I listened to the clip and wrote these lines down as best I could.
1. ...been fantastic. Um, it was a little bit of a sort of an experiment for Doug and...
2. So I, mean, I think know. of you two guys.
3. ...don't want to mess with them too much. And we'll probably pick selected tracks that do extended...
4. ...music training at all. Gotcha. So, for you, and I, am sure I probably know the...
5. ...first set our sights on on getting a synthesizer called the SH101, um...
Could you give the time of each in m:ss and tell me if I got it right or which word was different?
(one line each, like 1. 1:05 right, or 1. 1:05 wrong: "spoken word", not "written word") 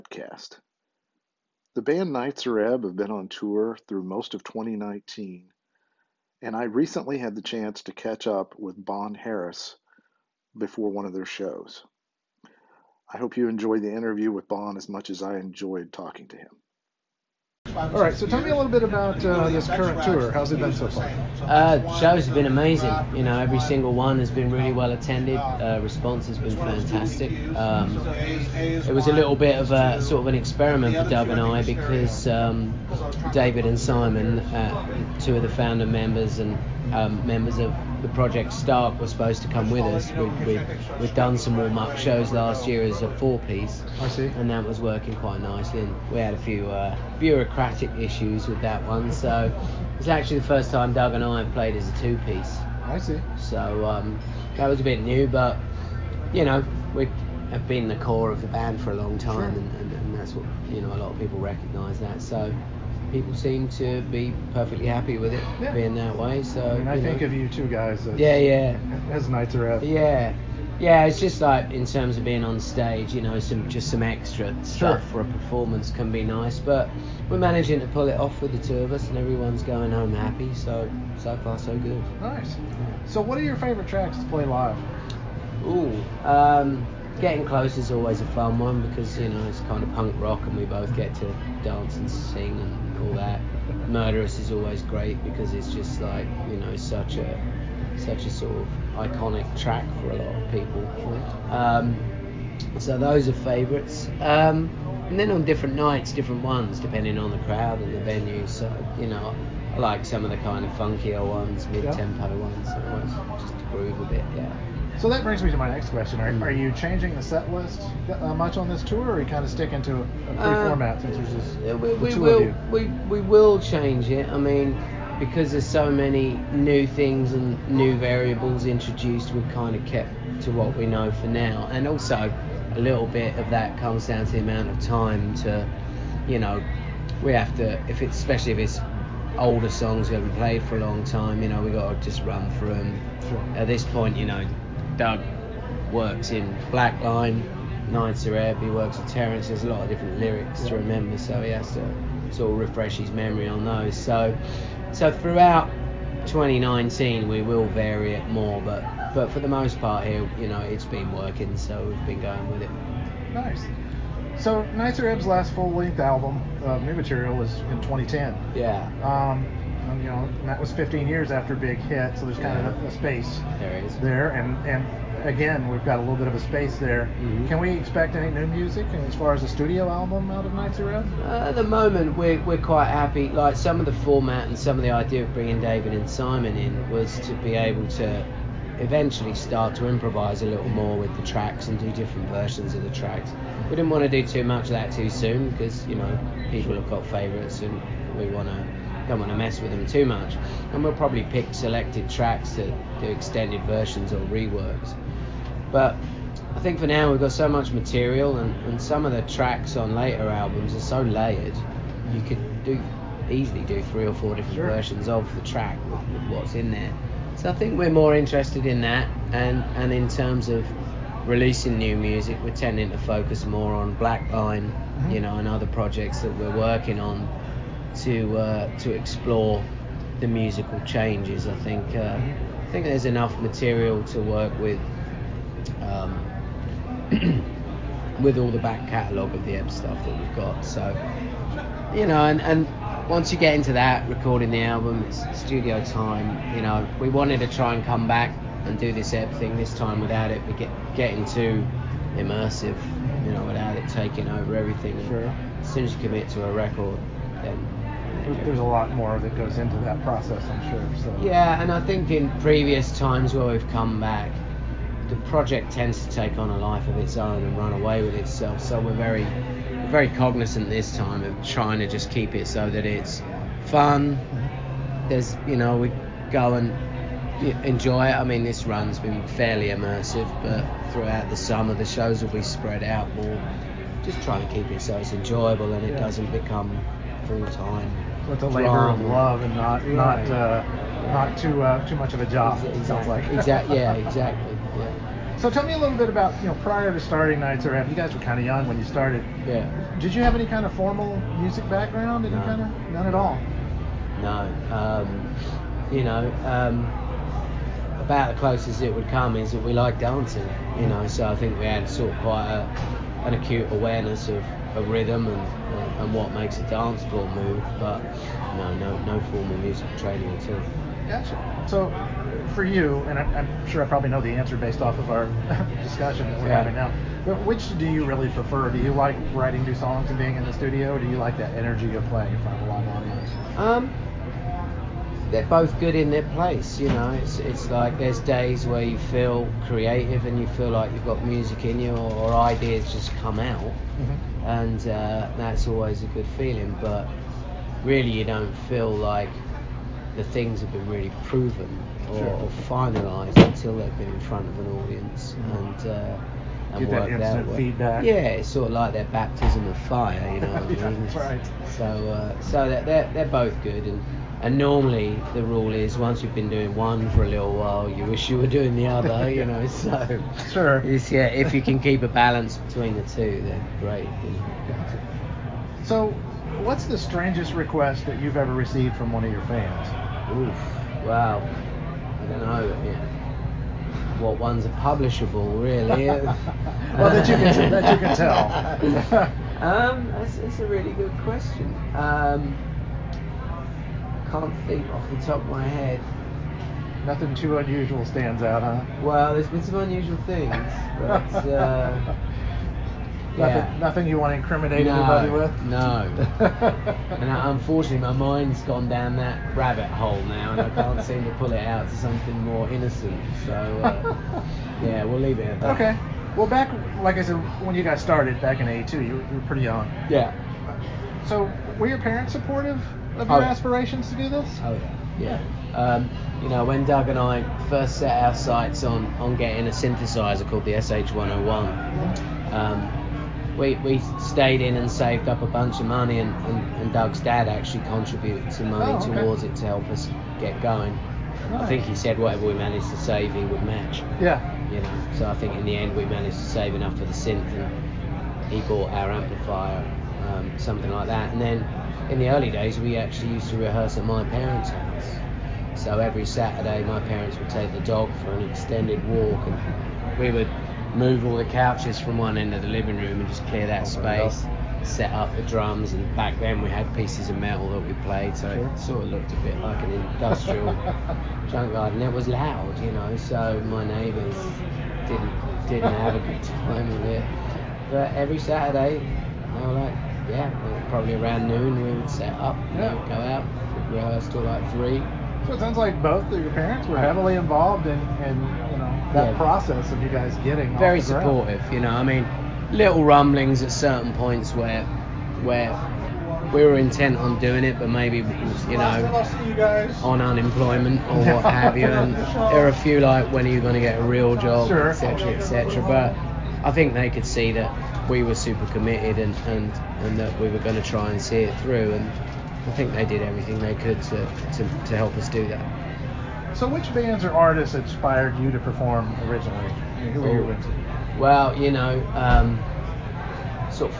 1. 0:26 right
2. 1:06 right
3. 3:19 right
4. 5:19 right
5. 7:07 right.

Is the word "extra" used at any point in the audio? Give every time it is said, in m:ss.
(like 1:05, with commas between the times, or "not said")
1:14.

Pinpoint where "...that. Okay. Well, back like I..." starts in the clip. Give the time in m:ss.
6:55.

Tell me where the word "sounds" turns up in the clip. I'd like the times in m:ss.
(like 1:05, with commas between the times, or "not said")
4:52, 8:05.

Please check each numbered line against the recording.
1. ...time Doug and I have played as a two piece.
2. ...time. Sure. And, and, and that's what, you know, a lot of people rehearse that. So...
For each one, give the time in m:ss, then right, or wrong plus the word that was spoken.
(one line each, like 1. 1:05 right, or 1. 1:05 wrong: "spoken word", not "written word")
1. 0:50 right
2. 0:59 wrong: "recognise", not "rehearse".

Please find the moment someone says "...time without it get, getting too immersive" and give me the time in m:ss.
4:09.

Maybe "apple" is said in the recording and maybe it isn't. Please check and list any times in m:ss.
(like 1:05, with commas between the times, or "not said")
not said.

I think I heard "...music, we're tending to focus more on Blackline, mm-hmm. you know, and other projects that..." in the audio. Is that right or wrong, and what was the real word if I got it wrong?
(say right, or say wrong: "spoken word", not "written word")
right.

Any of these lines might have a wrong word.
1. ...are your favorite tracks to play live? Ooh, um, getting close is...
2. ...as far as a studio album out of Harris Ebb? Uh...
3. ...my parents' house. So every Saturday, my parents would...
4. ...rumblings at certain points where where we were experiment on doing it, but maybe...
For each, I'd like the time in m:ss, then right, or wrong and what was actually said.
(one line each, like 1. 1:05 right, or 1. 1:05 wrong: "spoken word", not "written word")
1. 1:23 right
2. 2:59 wrong: "Nitzer", not "Harris"
3. 7:34 right
4. 8:13 wrong: "intent", not "experiment".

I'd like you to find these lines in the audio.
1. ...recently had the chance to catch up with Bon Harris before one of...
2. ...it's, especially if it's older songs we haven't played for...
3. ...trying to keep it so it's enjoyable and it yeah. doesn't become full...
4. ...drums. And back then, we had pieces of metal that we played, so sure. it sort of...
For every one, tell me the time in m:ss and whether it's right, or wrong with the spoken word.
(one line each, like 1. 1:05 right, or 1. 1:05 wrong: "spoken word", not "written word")
1. 0:06 right
2. 2:18 right
3. 4:44 right
4. 7:45 right.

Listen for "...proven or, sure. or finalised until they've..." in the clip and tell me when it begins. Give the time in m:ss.
5:51.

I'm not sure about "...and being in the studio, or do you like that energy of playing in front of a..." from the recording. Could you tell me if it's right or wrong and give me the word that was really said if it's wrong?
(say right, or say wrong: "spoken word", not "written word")
right.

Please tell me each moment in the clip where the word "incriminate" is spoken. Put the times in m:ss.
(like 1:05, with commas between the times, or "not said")
6:44.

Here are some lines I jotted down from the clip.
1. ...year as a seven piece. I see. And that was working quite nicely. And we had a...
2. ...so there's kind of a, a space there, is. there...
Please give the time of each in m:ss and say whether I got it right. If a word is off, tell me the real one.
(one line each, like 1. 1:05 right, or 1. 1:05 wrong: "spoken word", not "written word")
1. 0:42 wrong: "four", not "seven"
2. 2:52 right.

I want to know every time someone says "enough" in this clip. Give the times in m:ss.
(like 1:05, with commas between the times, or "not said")
3:53, 7:26.